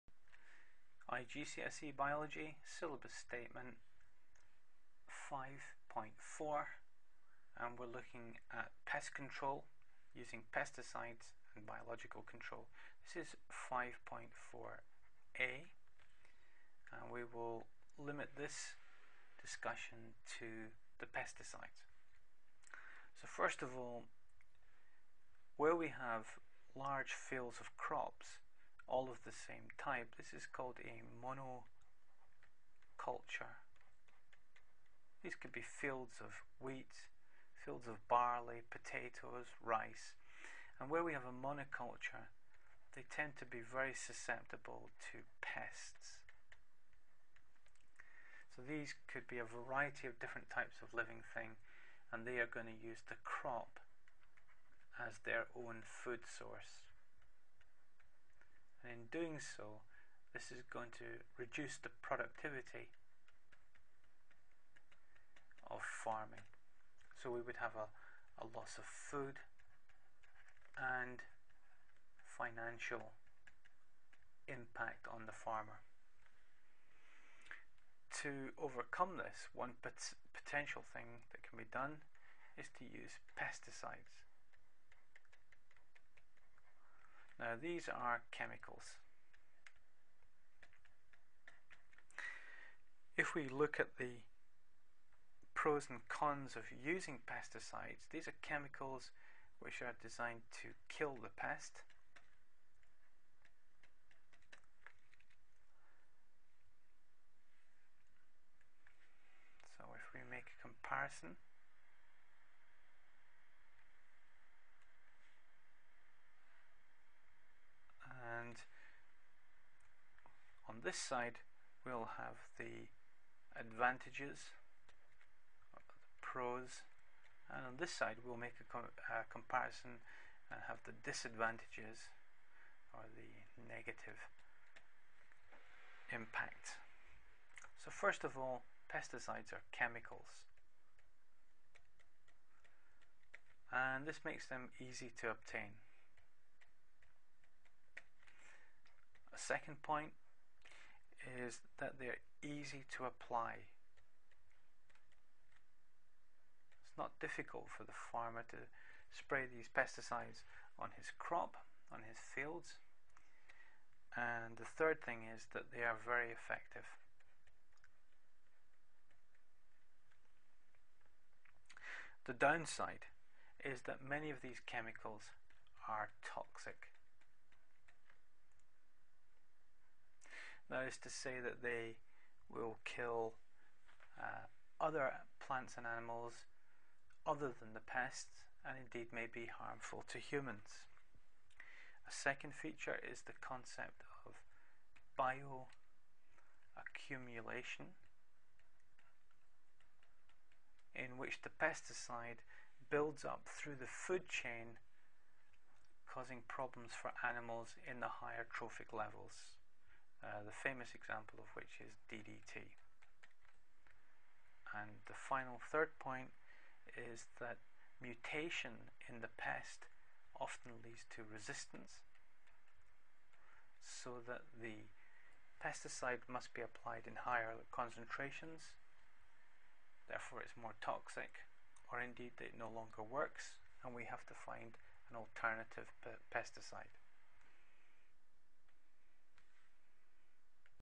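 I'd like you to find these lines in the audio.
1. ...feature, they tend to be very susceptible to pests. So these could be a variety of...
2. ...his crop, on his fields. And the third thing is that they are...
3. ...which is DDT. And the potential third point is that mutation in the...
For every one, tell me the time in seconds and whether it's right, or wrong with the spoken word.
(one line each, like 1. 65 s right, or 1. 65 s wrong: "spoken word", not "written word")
1. 41 s wrong: "monoculture", not "feature"
2. 160 s right
3. 211 s wrong: "final", not "potential".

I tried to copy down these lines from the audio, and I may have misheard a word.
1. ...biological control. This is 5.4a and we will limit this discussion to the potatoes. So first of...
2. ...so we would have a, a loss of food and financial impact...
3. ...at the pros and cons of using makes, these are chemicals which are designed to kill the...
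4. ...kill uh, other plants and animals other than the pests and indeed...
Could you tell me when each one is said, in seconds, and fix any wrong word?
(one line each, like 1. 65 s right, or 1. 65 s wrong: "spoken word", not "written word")
1. 11 s wrong: "pesticides", not "potatoes"
2. 67 s right
3. 93 s wrong: "pesticides", not "makes"
4. 182 s right.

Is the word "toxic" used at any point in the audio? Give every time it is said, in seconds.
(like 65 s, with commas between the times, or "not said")
176 s, 230 s.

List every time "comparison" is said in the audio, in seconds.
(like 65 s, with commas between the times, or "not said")
110 s, 129 s.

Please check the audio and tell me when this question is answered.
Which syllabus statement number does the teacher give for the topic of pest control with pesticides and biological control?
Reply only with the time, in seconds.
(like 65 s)
5 s.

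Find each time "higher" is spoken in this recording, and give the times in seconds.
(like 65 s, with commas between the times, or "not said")
208 s, 227 s.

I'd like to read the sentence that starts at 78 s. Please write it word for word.
To overcome this, one pot potential thing that can be done is to use pesticides.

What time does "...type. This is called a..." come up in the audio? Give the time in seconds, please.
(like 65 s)
29 s.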